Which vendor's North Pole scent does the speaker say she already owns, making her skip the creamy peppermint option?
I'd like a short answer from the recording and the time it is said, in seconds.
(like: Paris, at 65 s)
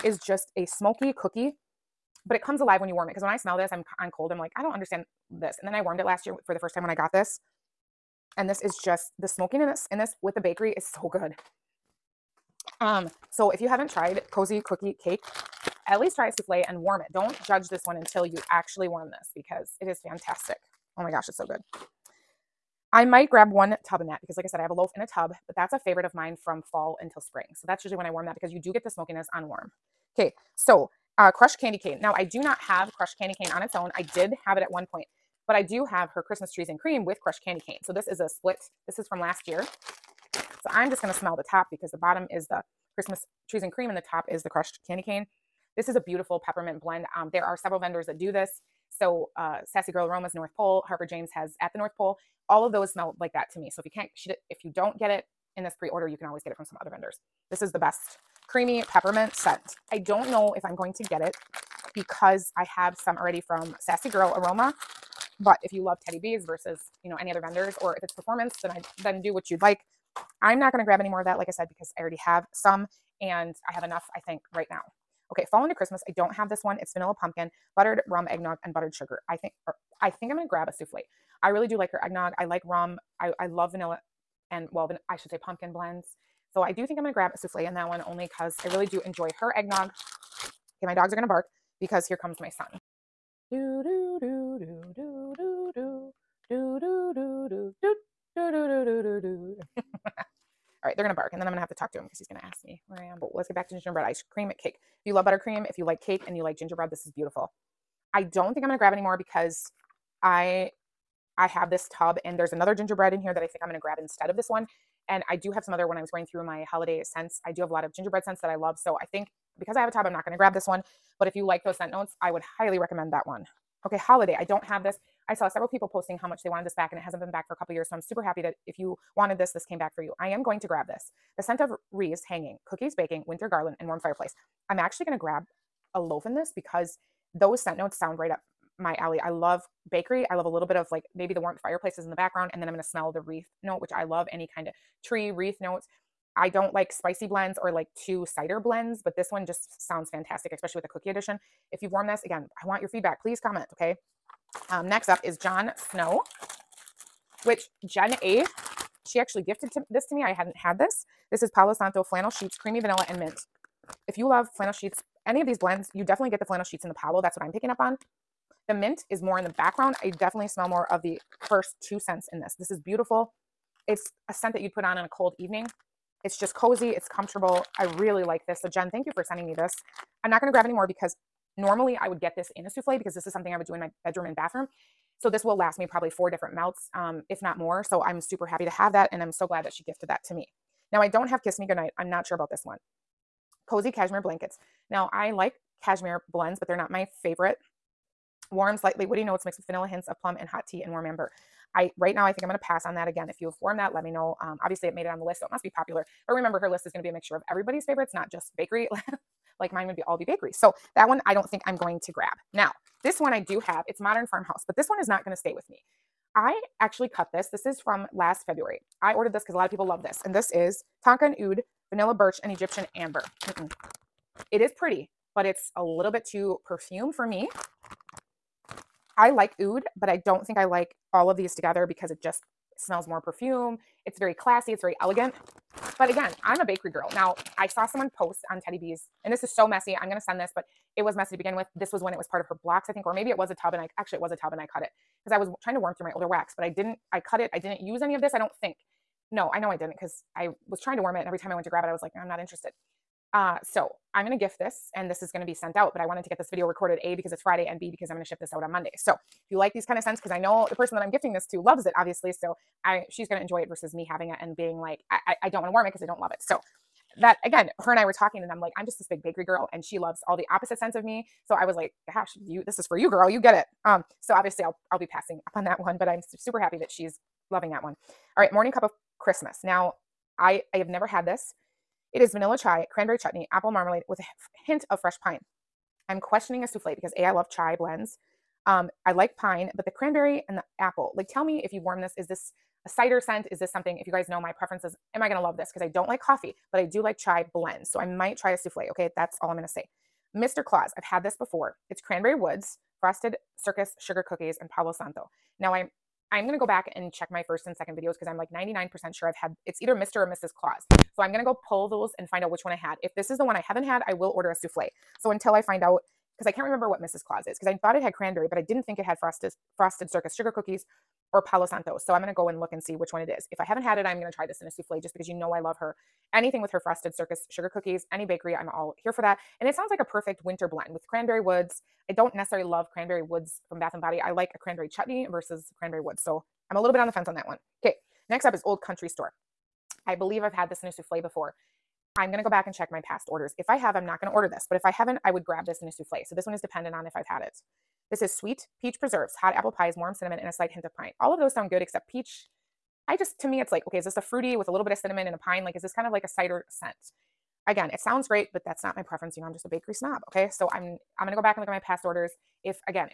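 Sassy Girl Aromas, at 63 s.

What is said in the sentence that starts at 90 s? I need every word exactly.
Okay, my dogs are going to bark because here comes my son.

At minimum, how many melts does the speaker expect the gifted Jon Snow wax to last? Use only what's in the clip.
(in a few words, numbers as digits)
4.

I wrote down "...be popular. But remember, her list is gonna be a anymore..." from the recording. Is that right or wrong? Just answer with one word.
wrong.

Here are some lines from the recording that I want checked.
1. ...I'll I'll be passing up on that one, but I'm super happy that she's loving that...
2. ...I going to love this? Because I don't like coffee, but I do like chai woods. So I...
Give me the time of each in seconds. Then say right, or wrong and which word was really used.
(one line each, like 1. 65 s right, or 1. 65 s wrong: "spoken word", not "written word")
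1. 274 s right
2. 295 s wrong: "blends", not "woods".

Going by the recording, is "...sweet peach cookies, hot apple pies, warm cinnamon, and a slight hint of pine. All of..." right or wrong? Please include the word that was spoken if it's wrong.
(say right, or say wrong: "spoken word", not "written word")
wrong: "preserves", not "cookies".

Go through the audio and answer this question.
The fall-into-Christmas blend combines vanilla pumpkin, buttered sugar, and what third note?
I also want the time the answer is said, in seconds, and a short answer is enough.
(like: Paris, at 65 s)
buttered rum eggnog, at 77 s.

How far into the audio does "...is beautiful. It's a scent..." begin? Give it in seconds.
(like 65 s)
172 s.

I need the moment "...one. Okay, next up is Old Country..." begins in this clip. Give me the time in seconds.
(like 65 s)
337 s.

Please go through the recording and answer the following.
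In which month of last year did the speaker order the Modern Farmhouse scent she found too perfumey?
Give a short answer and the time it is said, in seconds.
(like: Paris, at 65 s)
February, at 218 s.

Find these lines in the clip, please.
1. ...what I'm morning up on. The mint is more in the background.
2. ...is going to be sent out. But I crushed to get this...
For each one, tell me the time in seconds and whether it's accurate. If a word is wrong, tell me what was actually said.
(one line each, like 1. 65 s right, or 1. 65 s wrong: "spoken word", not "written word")
1. 167 s wrong: "picking", not "morning"
2. 255 s wrong: "wanted", not "crushed".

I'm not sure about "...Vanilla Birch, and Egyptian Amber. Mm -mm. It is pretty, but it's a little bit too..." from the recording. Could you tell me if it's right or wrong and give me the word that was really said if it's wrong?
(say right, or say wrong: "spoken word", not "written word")
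right.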